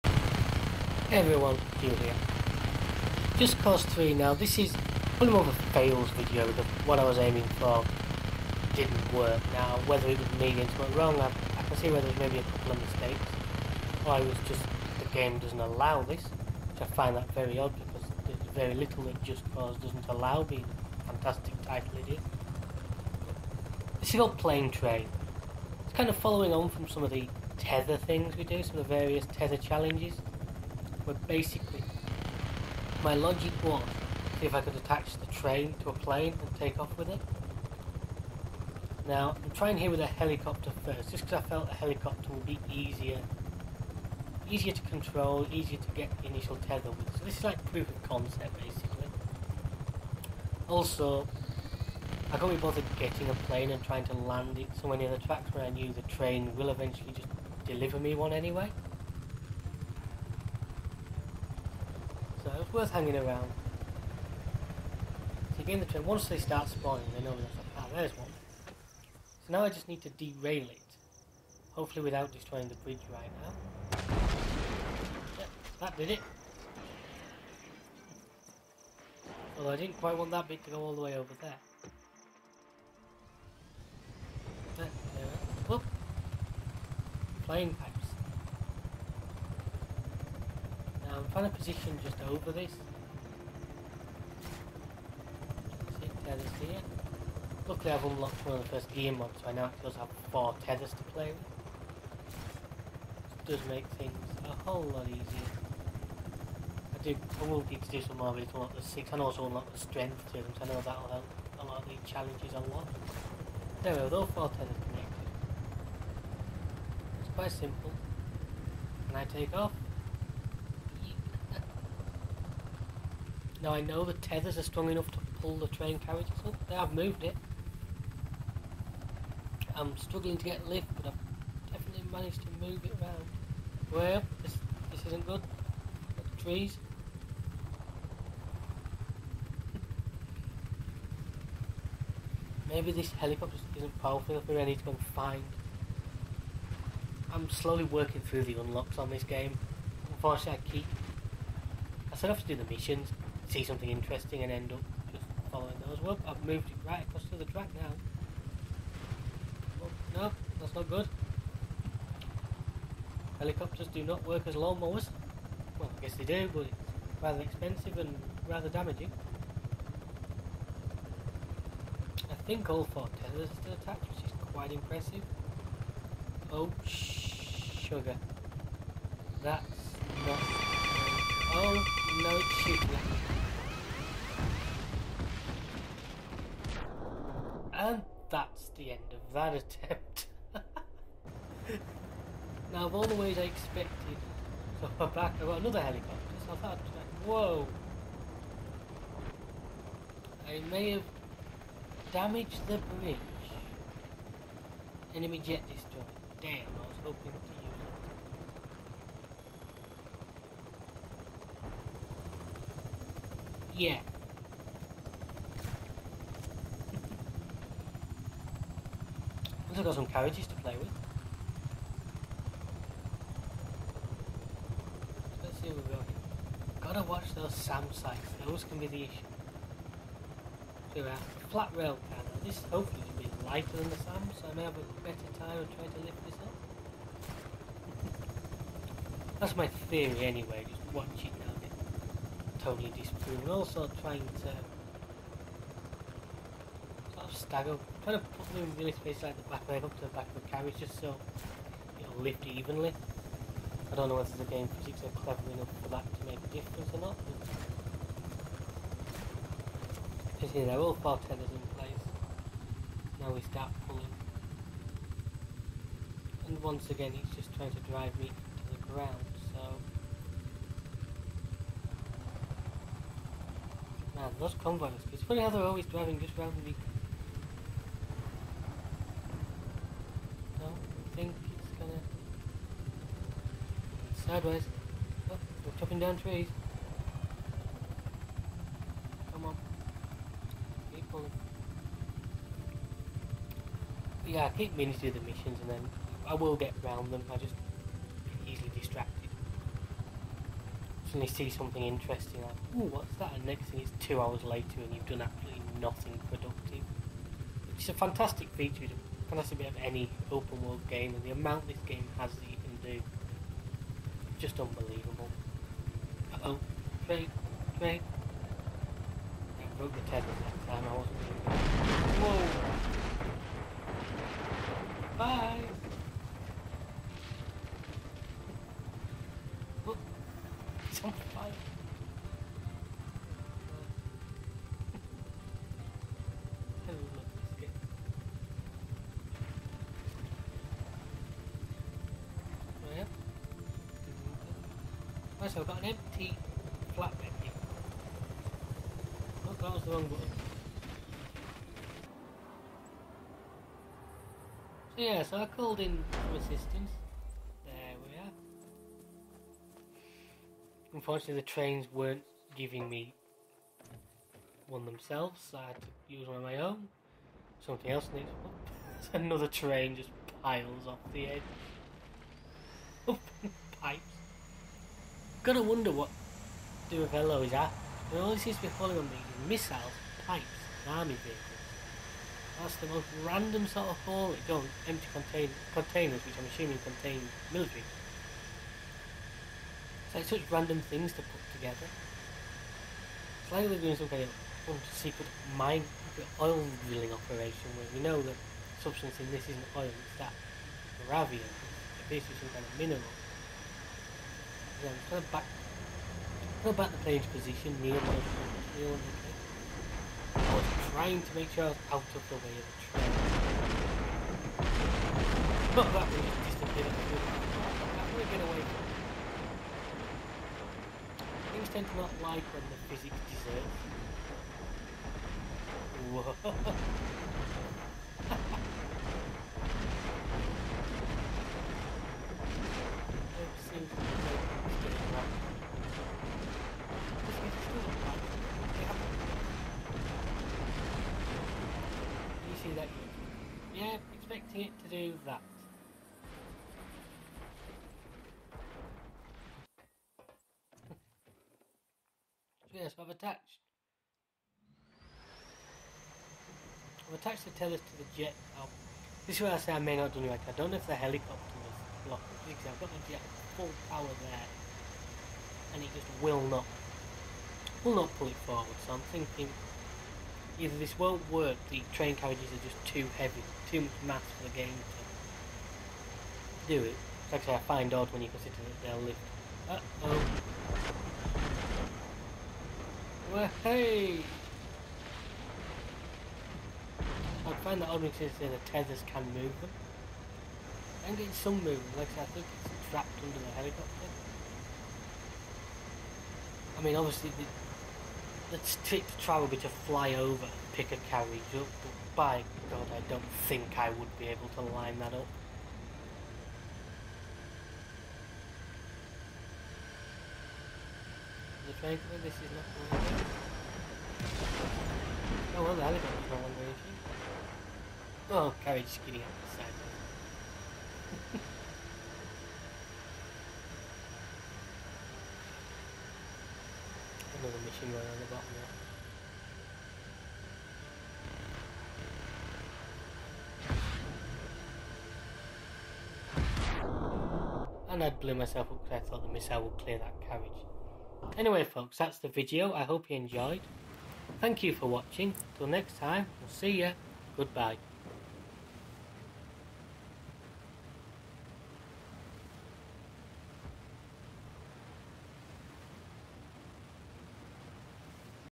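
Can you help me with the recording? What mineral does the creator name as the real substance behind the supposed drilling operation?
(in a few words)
Bavarium.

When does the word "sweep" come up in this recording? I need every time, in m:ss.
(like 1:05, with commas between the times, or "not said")
not said.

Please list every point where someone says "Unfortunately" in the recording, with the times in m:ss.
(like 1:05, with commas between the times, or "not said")
2:30, 6:00.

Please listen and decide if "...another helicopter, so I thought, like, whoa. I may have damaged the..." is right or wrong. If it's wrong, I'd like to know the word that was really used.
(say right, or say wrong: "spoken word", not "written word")
right.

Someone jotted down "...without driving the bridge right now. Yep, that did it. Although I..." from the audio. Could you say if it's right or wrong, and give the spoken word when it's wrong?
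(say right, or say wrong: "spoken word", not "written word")
wrong: "destroying", not "driving".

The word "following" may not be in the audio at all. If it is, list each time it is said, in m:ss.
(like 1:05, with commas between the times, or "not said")
0:26, 2:35, 6:18.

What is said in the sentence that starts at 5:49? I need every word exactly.
Oh, that was the wrong button.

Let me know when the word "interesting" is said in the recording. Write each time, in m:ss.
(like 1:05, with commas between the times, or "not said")
2:33, 5:01.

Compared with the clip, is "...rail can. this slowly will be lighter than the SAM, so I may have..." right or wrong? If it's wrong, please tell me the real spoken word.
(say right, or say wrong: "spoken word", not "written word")
wrong: "hopefully", not "slowly".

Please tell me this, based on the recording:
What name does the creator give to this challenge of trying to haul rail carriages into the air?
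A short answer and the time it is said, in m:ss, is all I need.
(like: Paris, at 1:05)
Plane Train, at 0:24.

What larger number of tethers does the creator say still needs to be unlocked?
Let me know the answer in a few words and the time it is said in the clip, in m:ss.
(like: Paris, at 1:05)
6, at 1:48.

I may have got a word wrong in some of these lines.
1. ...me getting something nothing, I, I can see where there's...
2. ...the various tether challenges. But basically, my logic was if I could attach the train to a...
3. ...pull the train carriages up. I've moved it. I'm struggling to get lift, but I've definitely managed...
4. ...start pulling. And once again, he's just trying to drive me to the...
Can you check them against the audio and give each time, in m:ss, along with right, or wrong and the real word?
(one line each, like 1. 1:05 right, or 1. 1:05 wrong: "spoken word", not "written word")
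1. 0:10 wrong: "wrong", not "nothing"
2. 0:28 right
3. 2:05 right
4. 4:23 right.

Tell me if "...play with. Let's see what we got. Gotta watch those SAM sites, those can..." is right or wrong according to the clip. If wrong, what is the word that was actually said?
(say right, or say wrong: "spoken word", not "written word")
right.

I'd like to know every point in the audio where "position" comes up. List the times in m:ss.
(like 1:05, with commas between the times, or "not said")
1:31, 6:47.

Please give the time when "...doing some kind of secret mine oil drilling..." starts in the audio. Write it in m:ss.
6:33.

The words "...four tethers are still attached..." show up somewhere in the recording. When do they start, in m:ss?
2:52.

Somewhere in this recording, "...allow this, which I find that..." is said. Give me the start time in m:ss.
0:15.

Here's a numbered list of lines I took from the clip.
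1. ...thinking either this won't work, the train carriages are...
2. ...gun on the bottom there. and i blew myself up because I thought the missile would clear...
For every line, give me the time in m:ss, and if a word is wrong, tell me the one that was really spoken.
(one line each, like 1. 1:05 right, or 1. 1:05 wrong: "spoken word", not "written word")
1. 7:49 right
2. 8:47 right.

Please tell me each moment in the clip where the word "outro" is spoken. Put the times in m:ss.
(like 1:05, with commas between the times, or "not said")
not said.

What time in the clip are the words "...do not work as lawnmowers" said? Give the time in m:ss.
2:43.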